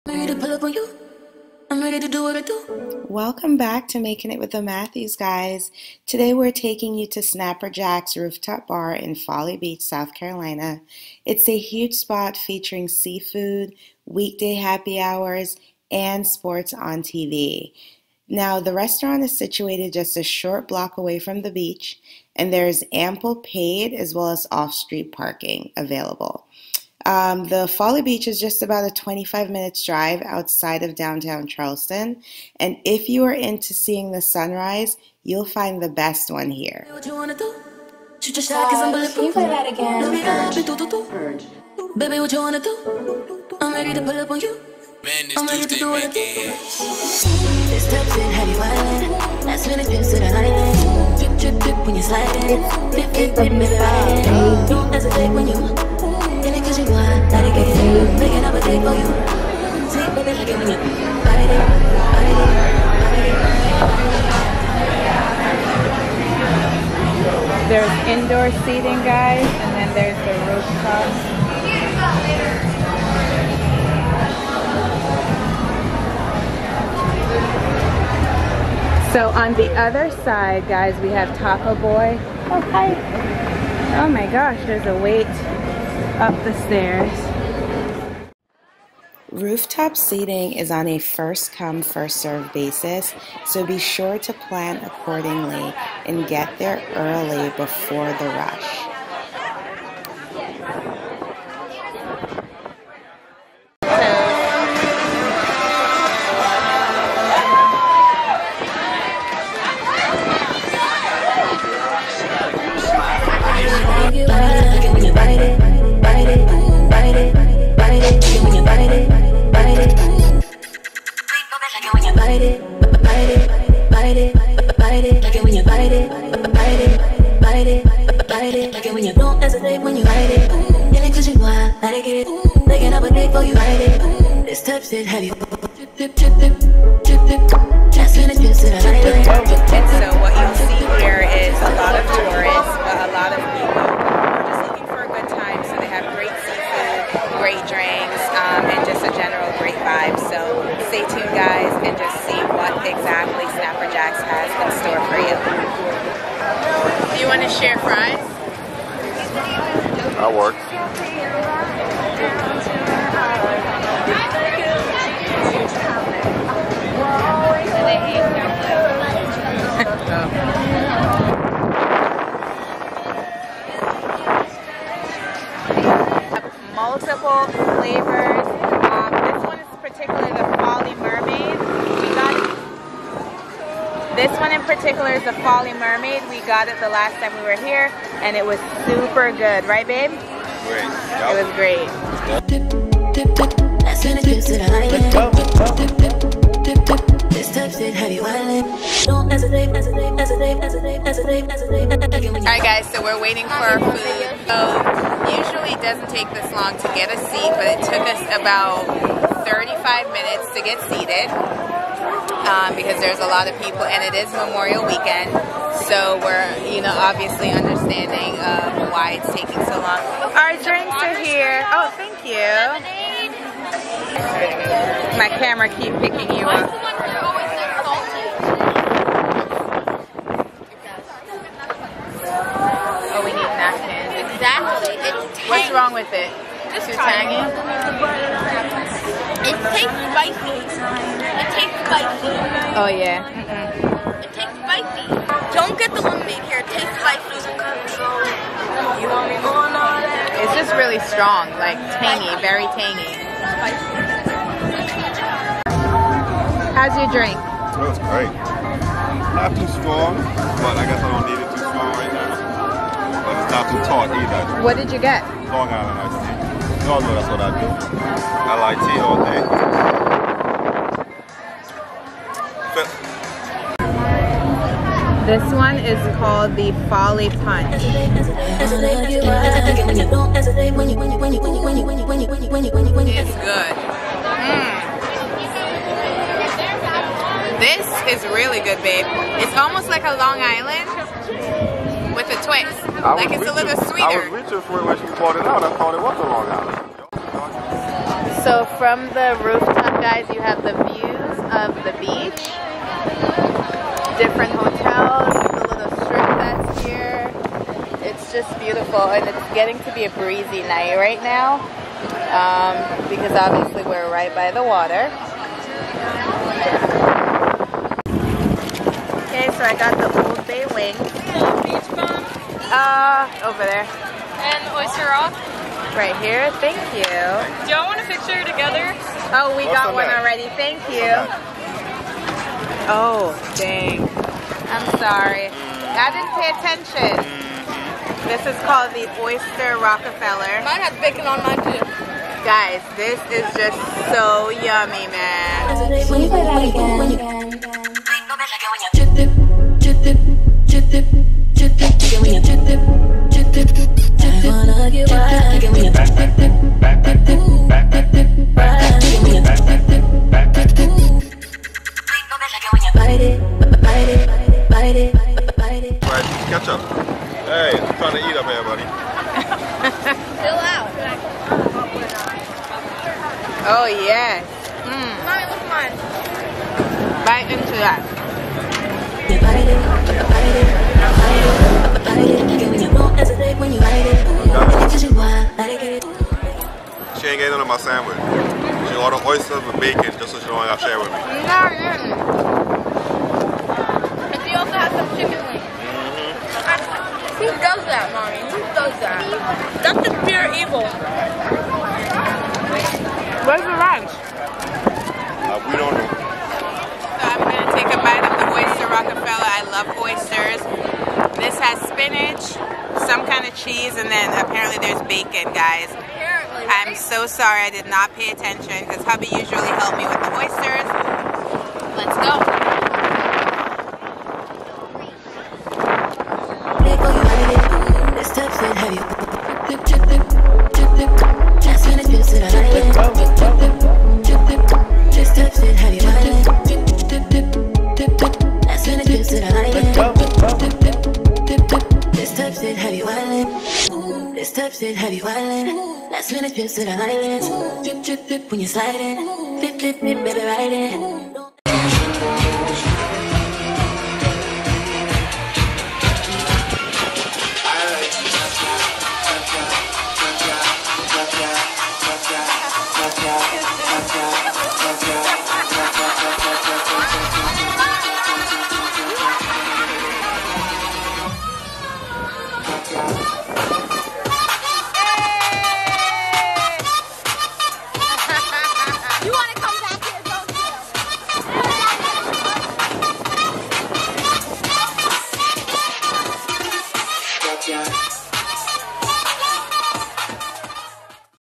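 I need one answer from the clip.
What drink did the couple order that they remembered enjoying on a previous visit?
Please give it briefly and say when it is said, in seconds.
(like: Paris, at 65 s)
Folly Mermaid, at 185 s.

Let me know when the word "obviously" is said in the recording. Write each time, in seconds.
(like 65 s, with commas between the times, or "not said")
216 s, 313 s.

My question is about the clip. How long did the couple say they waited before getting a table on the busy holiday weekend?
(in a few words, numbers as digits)
35 minutes.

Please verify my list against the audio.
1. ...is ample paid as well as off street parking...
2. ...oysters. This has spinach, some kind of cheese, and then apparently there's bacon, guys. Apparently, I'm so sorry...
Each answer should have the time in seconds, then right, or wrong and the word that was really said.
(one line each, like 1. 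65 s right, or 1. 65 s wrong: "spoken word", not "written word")
1. 22 s right
2. 410 s right.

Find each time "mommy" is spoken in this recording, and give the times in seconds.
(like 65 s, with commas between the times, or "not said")
375 s, 398 s.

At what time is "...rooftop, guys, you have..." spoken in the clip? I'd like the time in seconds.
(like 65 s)
299 s.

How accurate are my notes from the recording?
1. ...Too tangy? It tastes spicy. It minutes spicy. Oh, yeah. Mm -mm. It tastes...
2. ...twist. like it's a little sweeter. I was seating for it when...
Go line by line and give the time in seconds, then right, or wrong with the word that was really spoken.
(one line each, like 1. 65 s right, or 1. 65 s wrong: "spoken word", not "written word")
1. 236 s wrong: "tastes", not "minutes"
2. 292 s wrong: "reaching", not "seating".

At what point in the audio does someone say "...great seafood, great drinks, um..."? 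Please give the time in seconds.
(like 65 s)
146 s.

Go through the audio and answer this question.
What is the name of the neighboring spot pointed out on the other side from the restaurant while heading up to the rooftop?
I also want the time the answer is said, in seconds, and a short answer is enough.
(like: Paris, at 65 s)
Taco Boy, at 81 s.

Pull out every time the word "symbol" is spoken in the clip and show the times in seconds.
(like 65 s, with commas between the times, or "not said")
not said.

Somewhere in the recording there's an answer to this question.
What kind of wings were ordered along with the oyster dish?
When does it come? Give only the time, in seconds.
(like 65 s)
320 s.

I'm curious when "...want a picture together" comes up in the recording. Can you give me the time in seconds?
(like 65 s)
327 s.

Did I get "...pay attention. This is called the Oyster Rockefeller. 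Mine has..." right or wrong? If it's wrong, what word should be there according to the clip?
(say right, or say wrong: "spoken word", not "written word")
right.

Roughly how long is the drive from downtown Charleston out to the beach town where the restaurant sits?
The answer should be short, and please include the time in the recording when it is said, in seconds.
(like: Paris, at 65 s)
25 minutes, at 28 s.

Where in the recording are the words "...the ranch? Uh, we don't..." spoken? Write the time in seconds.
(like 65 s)
403 s.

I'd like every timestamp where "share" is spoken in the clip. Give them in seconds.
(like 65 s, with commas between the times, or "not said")
157 s, 390 s.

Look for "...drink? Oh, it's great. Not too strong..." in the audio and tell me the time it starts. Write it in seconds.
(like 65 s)
257 s.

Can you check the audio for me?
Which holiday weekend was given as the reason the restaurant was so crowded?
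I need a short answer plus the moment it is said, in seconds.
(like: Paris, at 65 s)
Memorial Weekend, at 214 s.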